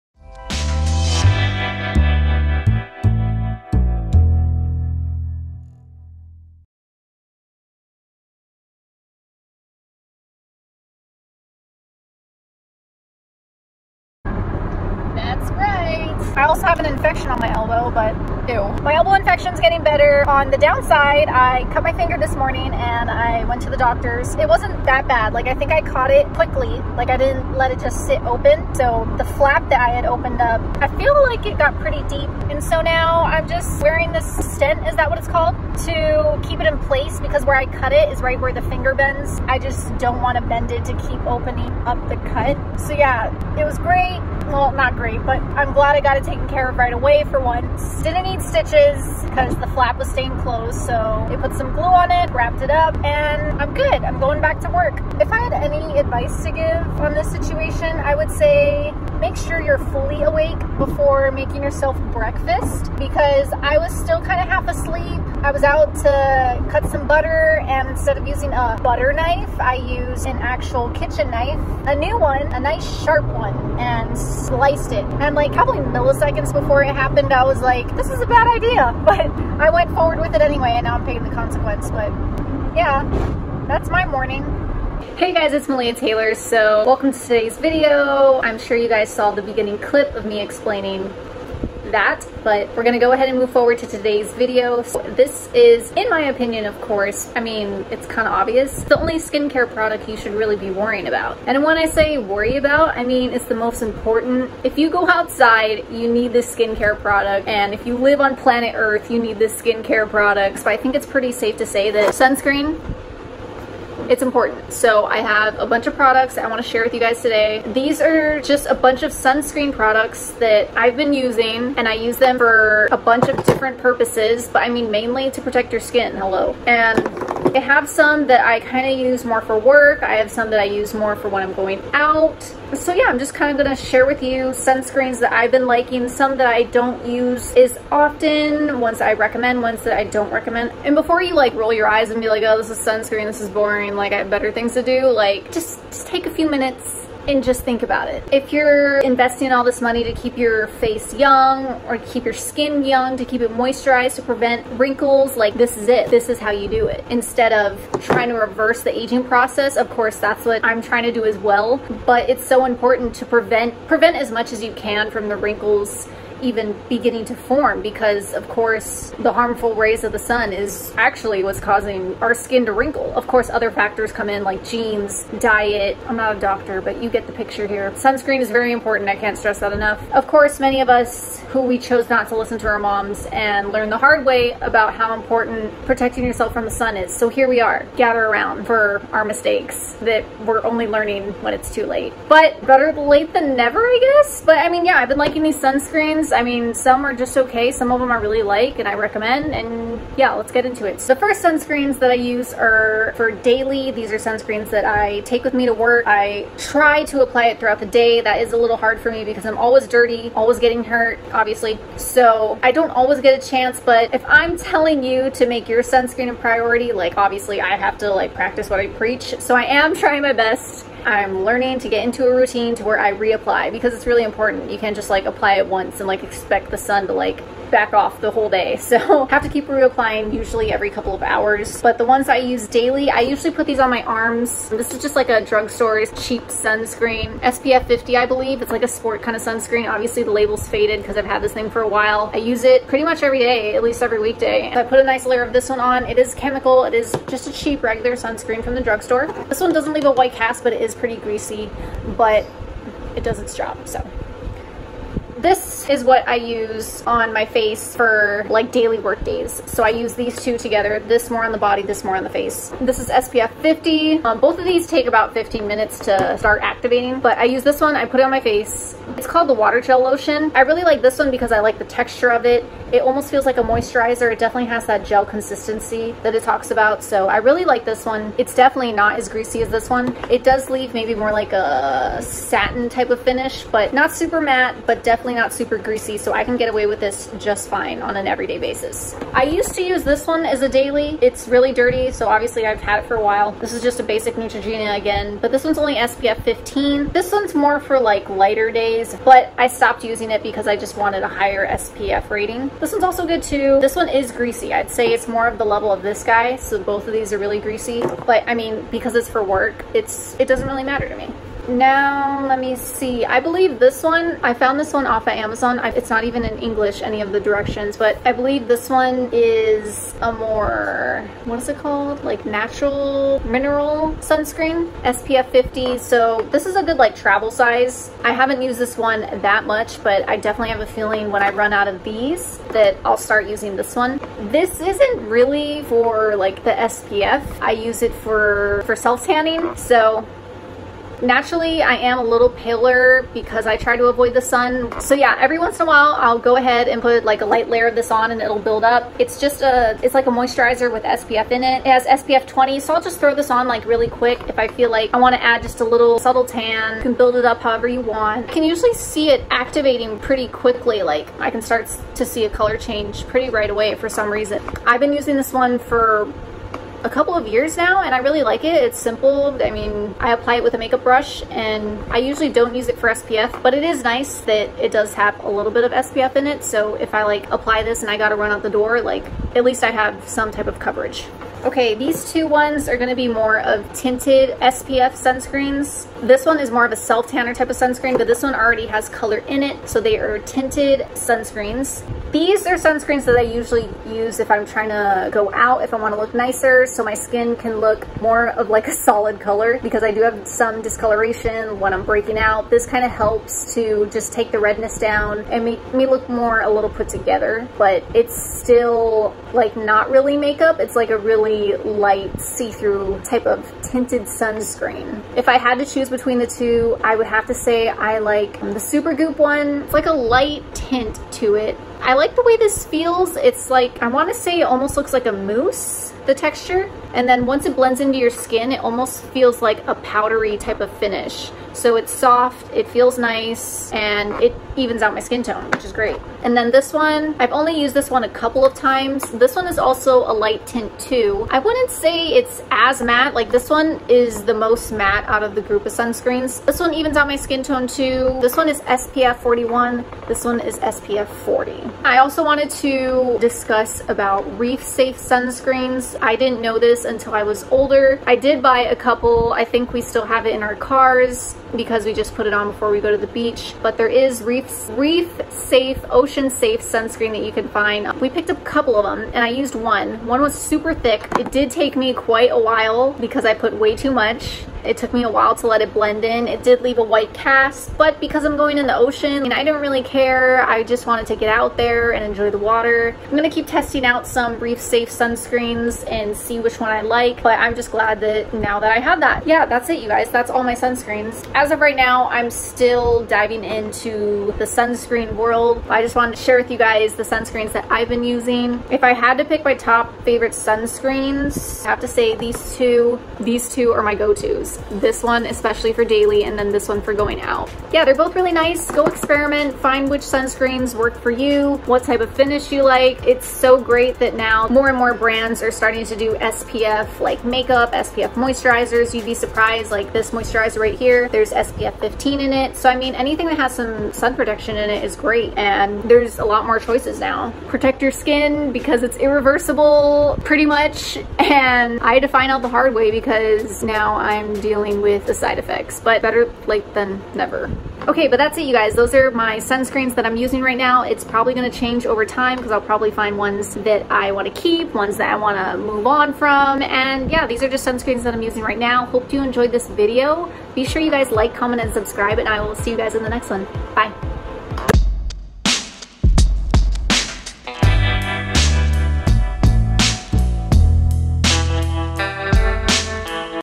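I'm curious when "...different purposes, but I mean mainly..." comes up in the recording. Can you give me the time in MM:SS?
02:03.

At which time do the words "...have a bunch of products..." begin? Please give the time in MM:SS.
01:55.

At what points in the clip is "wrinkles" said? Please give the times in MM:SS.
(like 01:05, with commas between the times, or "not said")
02:34, 02:45, 02:52.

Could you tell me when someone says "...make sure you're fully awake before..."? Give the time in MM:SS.
00:59.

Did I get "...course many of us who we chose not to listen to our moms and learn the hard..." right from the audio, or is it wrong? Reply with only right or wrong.
right.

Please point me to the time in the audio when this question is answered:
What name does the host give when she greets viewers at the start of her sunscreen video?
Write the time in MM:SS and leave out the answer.
01:25.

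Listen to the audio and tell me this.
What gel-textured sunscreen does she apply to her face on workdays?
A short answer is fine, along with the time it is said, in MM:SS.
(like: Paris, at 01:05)
water gel lotion, at 04:29.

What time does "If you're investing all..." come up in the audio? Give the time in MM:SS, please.
02:28.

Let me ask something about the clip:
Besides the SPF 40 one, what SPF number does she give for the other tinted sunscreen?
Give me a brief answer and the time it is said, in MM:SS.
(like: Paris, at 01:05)
SPF 41, at 07:28.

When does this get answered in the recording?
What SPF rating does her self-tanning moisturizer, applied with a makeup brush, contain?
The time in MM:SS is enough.
05:52.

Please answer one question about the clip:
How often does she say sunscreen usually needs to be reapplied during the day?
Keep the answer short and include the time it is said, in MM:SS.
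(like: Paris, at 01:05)
every couple of hours, at 03:50.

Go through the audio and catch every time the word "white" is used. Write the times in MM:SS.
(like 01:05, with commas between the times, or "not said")
04:10, 07:57.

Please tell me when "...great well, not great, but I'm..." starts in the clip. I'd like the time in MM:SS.
00:43.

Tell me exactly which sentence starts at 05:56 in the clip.
You can build it up however you want.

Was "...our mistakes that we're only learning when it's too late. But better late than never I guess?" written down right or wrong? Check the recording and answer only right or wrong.
right.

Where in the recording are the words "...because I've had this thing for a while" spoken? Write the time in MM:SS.
04:01.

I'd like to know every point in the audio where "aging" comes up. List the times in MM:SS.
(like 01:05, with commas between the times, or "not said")
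02:38.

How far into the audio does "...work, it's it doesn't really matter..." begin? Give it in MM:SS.
05:09.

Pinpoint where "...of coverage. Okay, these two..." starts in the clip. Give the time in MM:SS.
06:20.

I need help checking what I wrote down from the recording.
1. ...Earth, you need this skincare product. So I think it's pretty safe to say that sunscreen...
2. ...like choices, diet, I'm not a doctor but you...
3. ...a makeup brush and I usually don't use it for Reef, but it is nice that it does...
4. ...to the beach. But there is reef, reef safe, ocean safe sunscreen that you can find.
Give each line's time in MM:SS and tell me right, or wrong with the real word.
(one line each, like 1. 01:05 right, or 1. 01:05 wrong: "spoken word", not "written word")
1. 01:48 right
2. 02:54 wrong: "genes", not "choices"
3. 06:10 wrong: "SPF", not "Reef"
4. 07:43 right.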